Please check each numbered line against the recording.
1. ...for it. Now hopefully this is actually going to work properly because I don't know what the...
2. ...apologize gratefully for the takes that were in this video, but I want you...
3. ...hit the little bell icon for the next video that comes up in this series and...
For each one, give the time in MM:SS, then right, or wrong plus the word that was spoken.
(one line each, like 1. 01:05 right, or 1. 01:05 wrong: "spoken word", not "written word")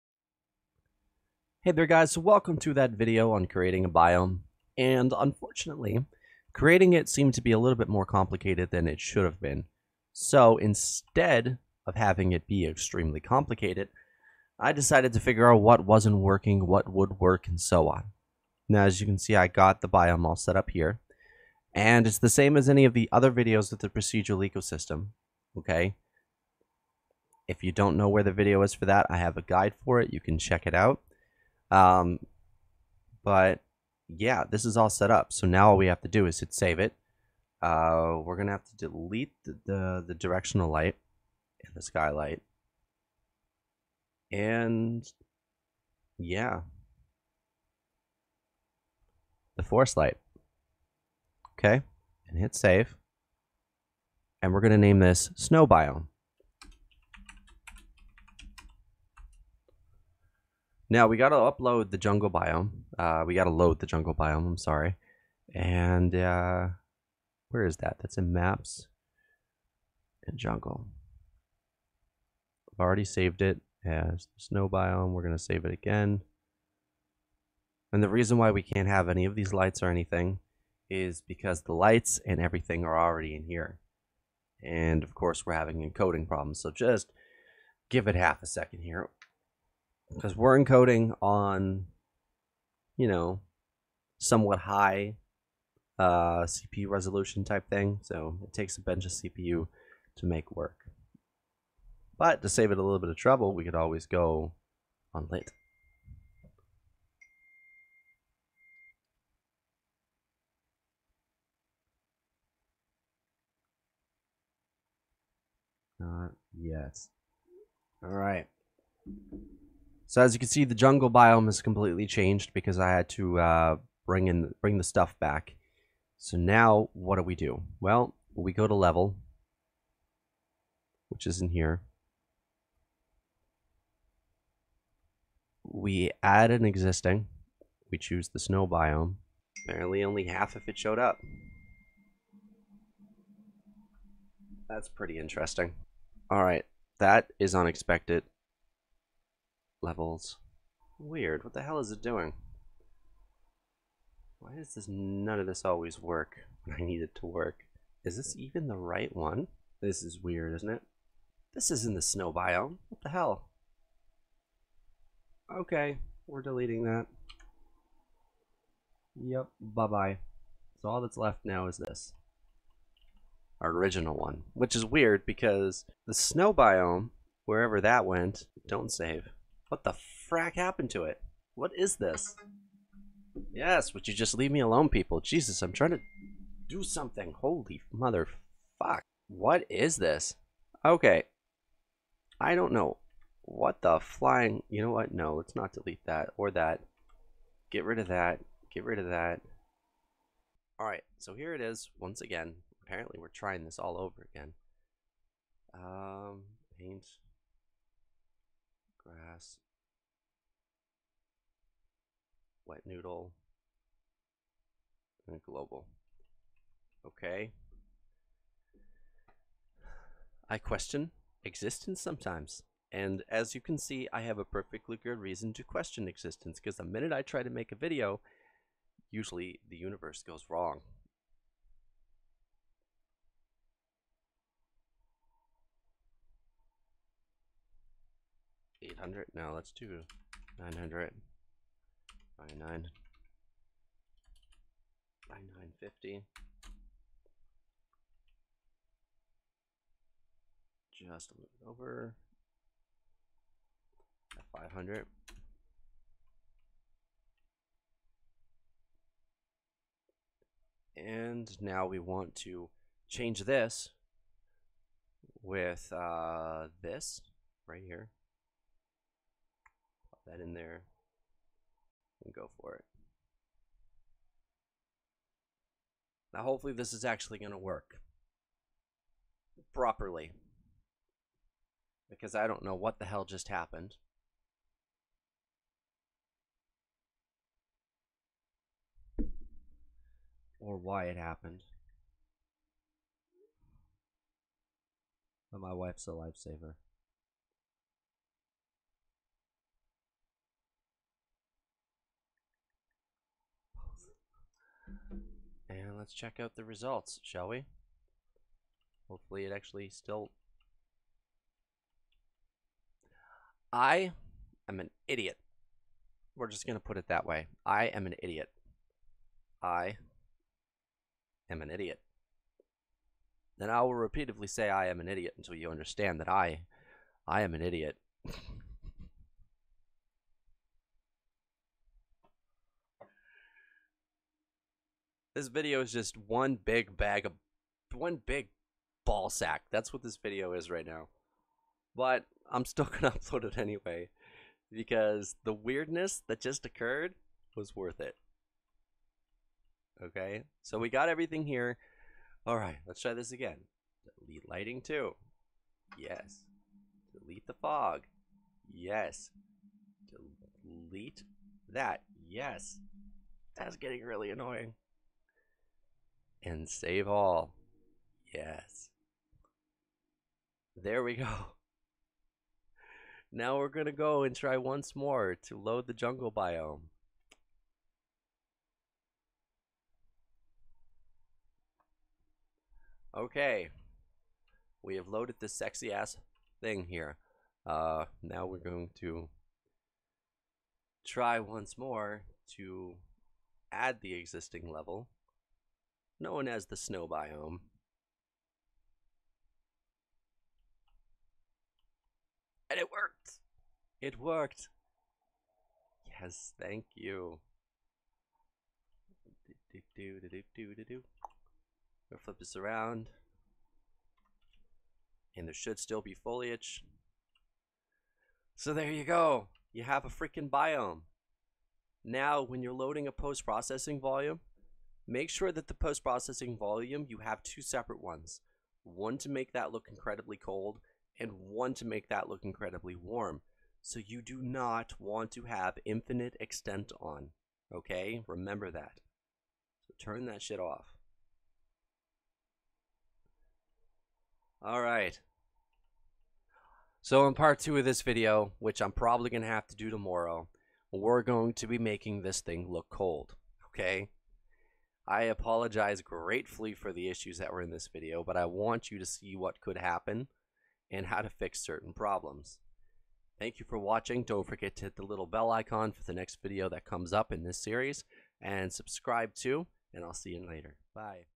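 1. 04:32 right
2. 07:35 wrong: "issues", not "takes"
3. 07:44 right.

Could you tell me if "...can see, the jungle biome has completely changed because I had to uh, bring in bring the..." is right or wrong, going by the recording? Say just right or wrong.
right.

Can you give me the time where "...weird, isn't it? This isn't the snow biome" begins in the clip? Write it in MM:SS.
02:40.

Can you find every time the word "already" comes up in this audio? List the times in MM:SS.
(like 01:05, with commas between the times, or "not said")
01:12, 01:22.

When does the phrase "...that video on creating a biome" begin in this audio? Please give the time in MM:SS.
00:02.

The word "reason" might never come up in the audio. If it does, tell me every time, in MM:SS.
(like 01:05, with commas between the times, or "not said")
01:18, 03:45.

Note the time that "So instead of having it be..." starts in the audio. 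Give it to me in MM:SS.
00:10.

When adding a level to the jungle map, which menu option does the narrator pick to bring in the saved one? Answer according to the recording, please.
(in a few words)
add an existing.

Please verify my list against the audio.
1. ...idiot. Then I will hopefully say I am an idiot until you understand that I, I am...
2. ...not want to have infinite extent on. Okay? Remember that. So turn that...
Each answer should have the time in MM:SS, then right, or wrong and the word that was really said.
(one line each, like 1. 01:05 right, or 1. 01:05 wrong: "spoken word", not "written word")
1. 05:21 wrong: "repeatedly", not "hopefully"
2. 07:14 right.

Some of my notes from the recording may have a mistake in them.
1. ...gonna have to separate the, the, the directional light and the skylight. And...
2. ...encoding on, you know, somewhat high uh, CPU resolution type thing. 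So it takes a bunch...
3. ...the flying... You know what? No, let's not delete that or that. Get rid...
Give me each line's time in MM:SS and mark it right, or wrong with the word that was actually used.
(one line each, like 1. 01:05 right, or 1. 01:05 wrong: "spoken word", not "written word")
1. 00:38 wrong: "delete", not "separate"
2. 01:30 right
3. 03:13 right.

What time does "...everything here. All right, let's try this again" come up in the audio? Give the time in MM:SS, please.
05:51.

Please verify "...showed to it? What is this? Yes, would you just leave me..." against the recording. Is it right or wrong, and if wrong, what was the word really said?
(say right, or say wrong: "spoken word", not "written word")
wrong: "happened", not "showed".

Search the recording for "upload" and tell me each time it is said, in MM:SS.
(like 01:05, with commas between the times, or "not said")
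01:01, 05:43.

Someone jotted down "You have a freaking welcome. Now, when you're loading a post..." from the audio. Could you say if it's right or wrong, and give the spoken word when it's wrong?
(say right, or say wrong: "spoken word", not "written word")
wrong: "biome", not "welcome".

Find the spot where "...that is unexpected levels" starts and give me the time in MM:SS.
02:26.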